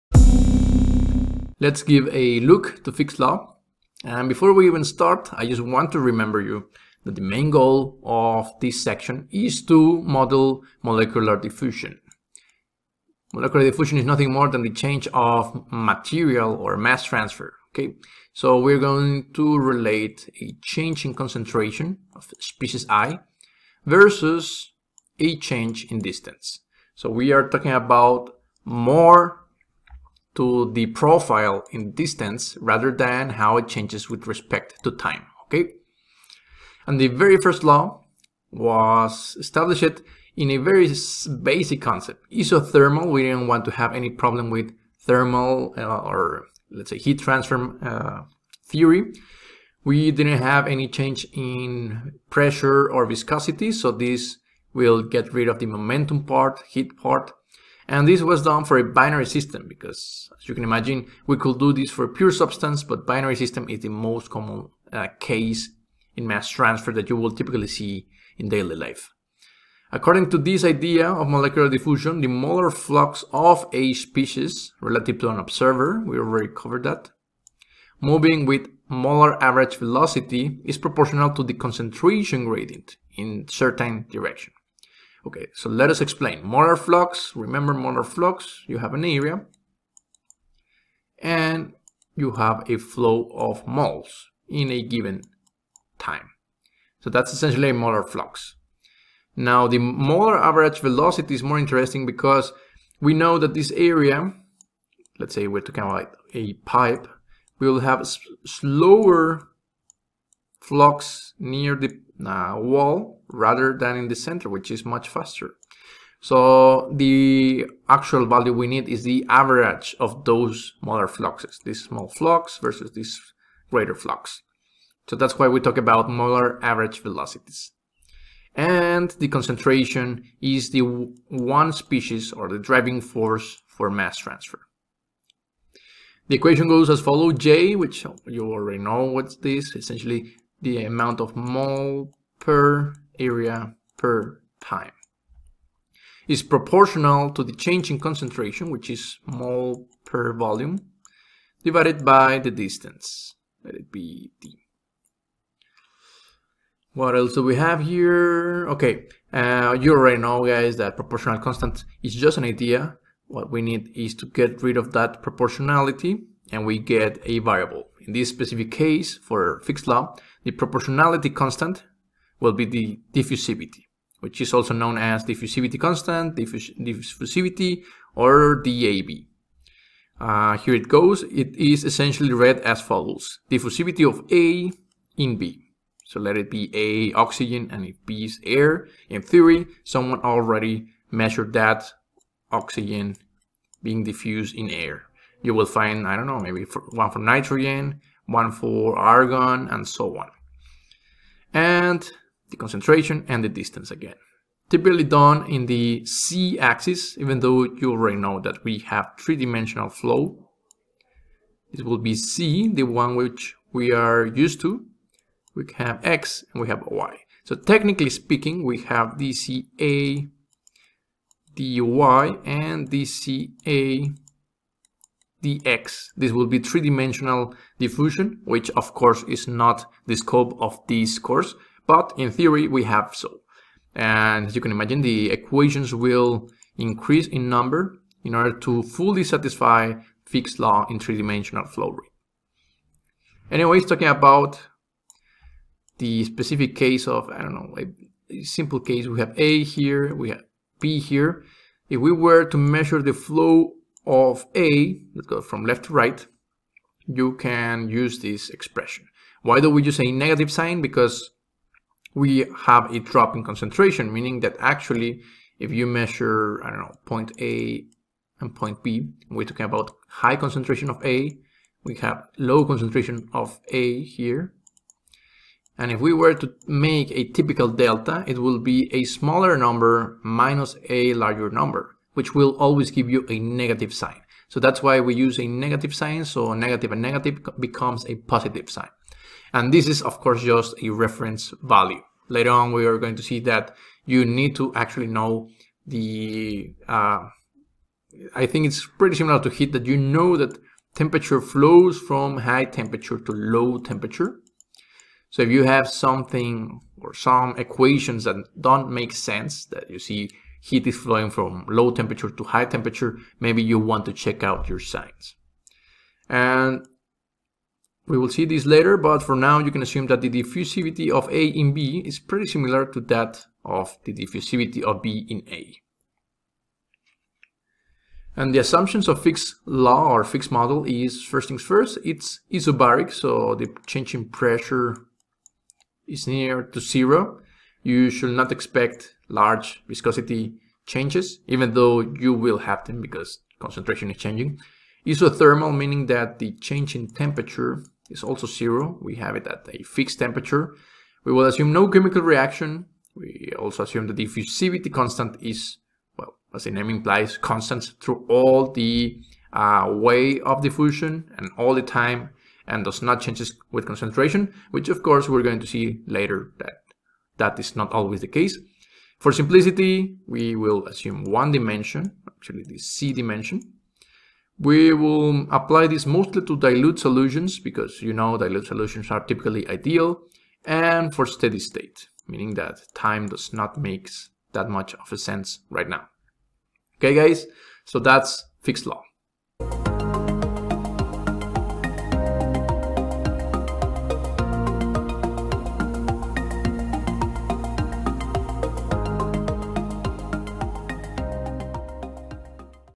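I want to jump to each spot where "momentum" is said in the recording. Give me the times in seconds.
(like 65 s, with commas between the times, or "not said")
55 s.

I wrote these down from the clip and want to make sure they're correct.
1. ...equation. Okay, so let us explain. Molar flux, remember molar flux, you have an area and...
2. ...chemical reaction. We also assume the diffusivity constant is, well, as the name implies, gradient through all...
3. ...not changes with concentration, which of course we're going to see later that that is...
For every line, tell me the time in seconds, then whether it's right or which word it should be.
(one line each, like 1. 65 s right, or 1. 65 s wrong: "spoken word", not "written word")
1. 84 s wrong: "direction", not "equation"
2. 351 s wrong: "constant", not "gradient"
3. 363 s right.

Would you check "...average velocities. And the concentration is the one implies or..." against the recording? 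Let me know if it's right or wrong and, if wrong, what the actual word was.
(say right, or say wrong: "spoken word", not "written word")
wrong: "species", not "implies".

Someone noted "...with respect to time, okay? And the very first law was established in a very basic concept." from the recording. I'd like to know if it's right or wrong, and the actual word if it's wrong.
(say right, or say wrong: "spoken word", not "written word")
right.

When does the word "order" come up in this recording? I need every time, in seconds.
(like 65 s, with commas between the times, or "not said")
238 s.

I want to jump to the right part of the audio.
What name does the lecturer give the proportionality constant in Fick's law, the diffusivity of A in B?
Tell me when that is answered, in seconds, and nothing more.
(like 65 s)
178 s.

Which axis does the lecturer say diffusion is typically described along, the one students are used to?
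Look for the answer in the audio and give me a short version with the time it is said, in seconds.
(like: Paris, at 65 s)
z-axis, at 206 s.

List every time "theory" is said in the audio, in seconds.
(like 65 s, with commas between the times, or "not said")
48 s, 189 s, 232 s.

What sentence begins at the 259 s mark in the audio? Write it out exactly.
Why do we use a negative sign?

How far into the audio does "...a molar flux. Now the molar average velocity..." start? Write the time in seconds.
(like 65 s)
97 s.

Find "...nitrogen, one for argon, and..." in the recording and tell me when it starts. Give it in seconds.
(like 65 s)
197 s.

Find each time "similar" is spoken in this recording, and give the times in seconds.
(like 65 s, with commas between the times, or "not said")
299 s, 322 s.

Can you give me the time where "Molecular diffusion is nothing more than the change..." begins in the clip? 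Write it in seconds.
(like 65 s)
13 s.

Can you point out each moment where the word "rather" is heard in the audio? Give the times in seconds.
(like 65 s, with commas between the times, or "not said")
32 s, 113 s.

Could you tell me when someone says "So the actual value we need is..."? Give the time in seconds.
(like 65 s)
116 s.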